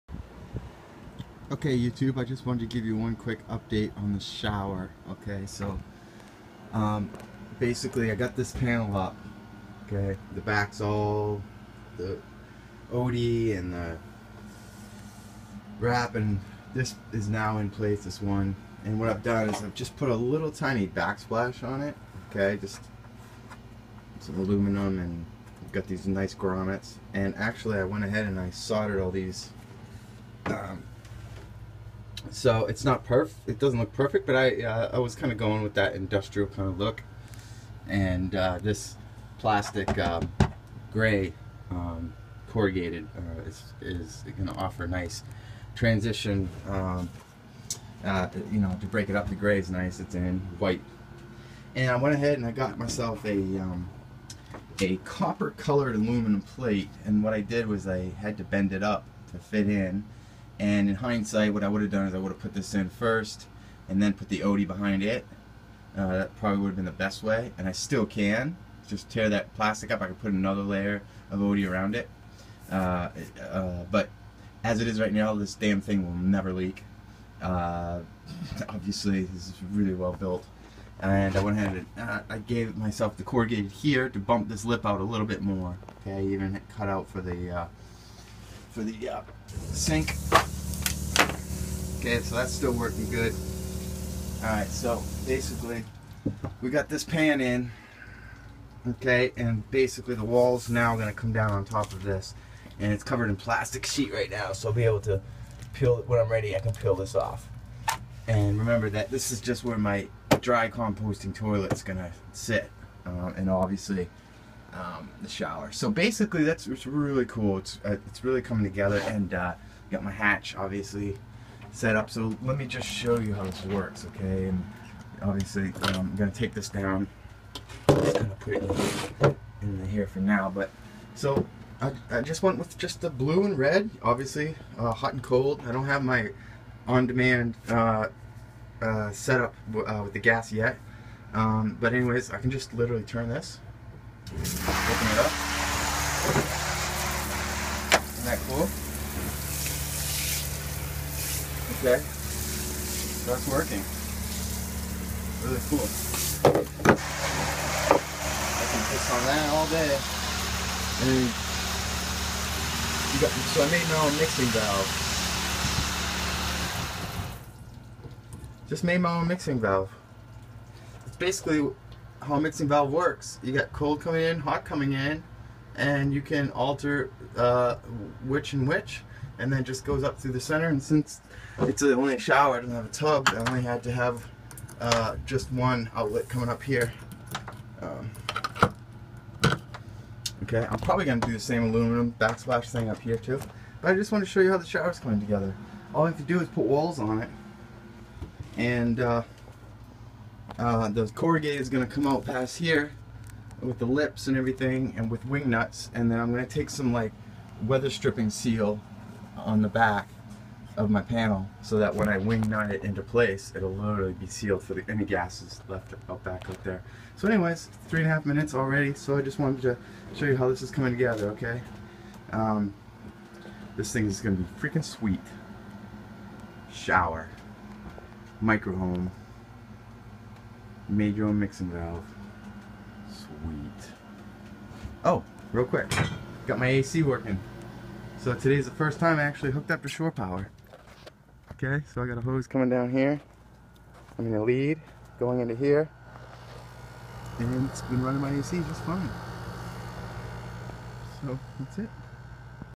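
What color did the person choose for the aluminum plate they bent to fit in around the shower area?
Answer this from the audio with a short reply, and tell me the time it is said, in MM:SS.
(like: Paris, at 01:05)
Copper colored, at 00:54.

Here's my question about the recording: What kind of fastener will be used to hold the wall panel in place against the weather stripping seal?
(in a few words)
Wing nuts.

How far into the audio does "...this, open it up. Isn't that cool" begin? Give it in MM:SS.
02:23.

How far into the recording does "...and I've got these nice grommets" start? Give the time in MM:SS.
00:24.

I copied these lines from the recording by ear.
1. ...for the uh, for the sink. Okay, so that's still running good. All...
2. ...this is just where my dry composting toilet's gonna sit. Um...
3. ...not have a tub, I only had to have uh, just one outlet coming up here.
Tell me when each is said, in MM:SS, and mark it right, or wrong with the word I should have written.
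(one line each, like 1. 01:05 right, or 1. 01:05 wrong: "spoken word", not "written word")
1. 01:27 wrong: "working", not "running"
2. 01:49 right
3. 03:02 right.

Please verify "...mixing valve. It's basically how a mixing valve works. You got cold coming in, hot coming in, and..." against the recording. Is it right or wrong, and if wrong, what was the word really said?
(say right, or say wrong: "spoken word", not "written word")
right.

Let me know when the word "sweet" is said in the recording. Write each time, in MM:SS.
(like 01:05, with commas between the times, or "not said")
03:44, 03:53.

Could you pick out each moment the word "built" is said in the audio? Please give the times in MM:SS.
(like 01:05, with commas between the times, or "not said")
01:20.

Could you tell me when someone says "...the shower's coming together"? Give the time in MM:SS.
03:14.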